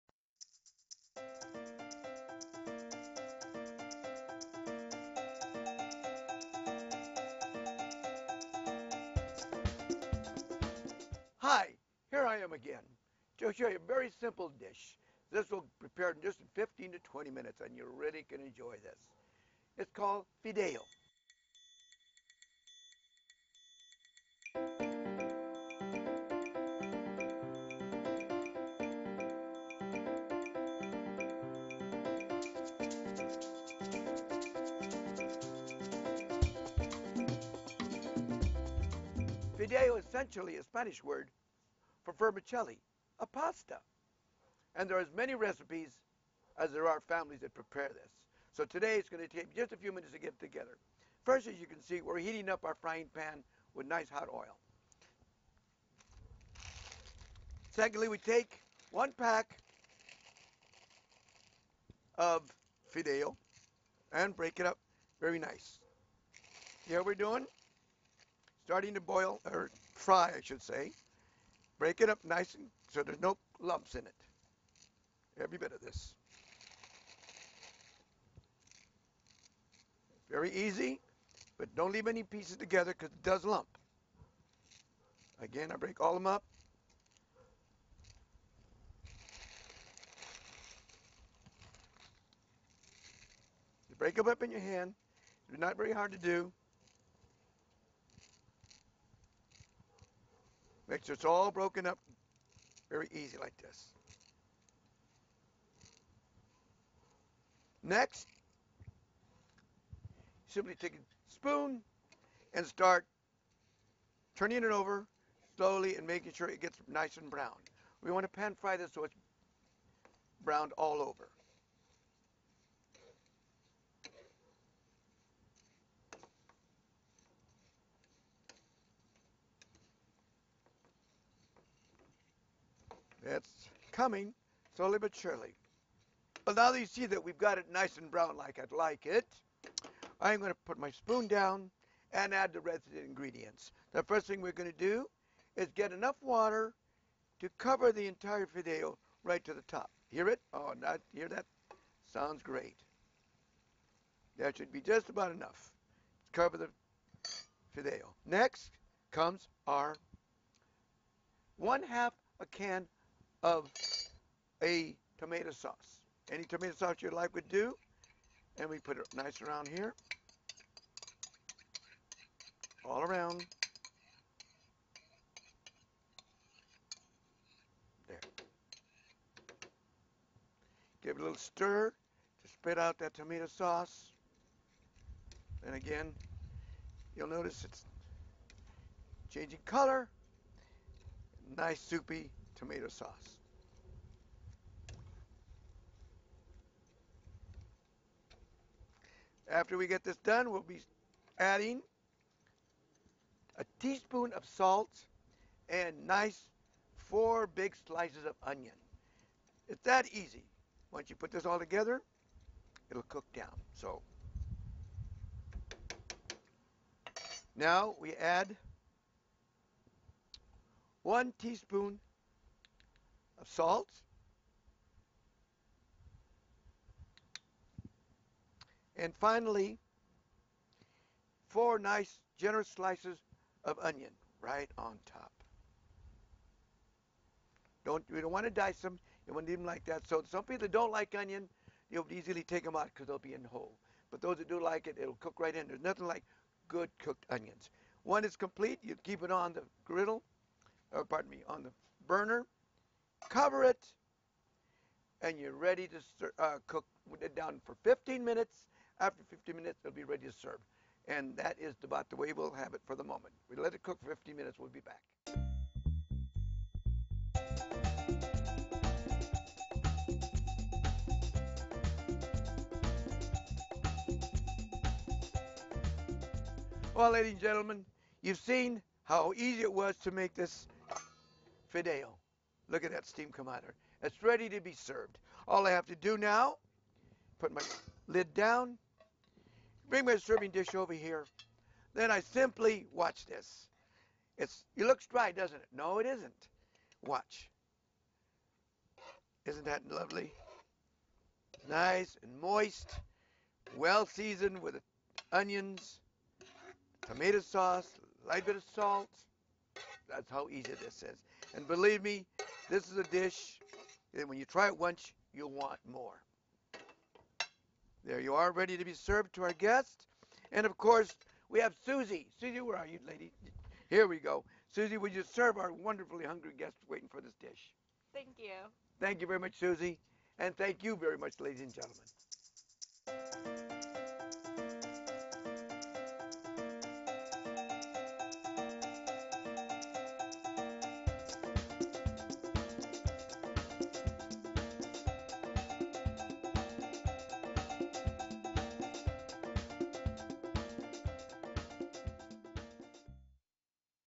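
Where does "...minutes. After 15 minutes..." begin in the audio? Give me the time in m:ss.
4:18.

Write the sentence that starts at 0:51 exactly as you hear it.
First, as you can see, we're heating up our frying pan with nice hot oil.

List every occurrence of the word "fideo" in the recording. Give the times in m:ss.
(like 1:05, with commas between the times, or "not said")
0:20, 0:39, 1:02, 2:28, 2:37, 4:41.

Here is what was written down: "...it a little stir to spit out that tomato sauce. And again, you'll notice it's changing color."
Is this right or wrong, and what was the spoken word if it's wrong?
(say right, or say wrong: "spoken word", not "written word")
right.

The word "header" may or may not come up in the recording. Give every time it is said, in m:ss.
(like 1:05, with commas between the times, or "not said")
not said.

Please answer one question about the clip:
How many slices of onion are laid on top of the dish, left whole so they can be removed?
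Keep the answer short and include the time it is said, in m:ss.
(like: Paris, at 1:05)
4, at 3:51.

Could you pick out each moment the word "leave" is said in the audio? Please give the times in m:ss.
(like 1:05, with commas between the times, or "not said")
1:21, 3:59.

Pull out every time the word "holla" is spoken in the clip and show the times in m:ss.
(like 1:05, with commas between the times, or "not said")
not said.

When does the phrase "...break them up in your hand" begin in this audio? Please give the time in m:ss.
1:33.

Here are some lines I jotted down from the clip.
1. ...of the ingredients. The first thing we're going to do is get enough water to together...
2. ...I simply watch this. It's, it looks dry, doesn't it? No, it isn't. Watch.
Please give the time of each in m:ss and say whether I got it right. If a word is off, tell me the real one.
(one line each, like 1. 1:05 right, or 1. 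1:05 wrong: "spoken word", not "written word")
1. 2:22 wrong: "cover", not "together"
2. 4:52 right.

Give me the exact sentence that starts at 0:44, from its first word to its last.
And there are as many recipes as there are families that prepare this.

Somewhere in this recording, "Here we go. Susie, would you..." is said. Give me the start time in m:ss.
5:23.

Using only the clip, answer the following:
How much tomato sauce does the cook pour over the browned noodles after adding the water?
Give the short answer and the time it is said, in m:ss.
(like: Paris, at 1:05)
half a can, at 2:41.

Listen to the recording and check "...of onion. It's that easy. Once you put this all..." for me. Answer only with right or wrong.
right.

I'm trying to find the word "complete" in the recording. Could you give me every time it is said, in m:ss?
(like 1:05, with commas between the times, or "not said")
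4:08.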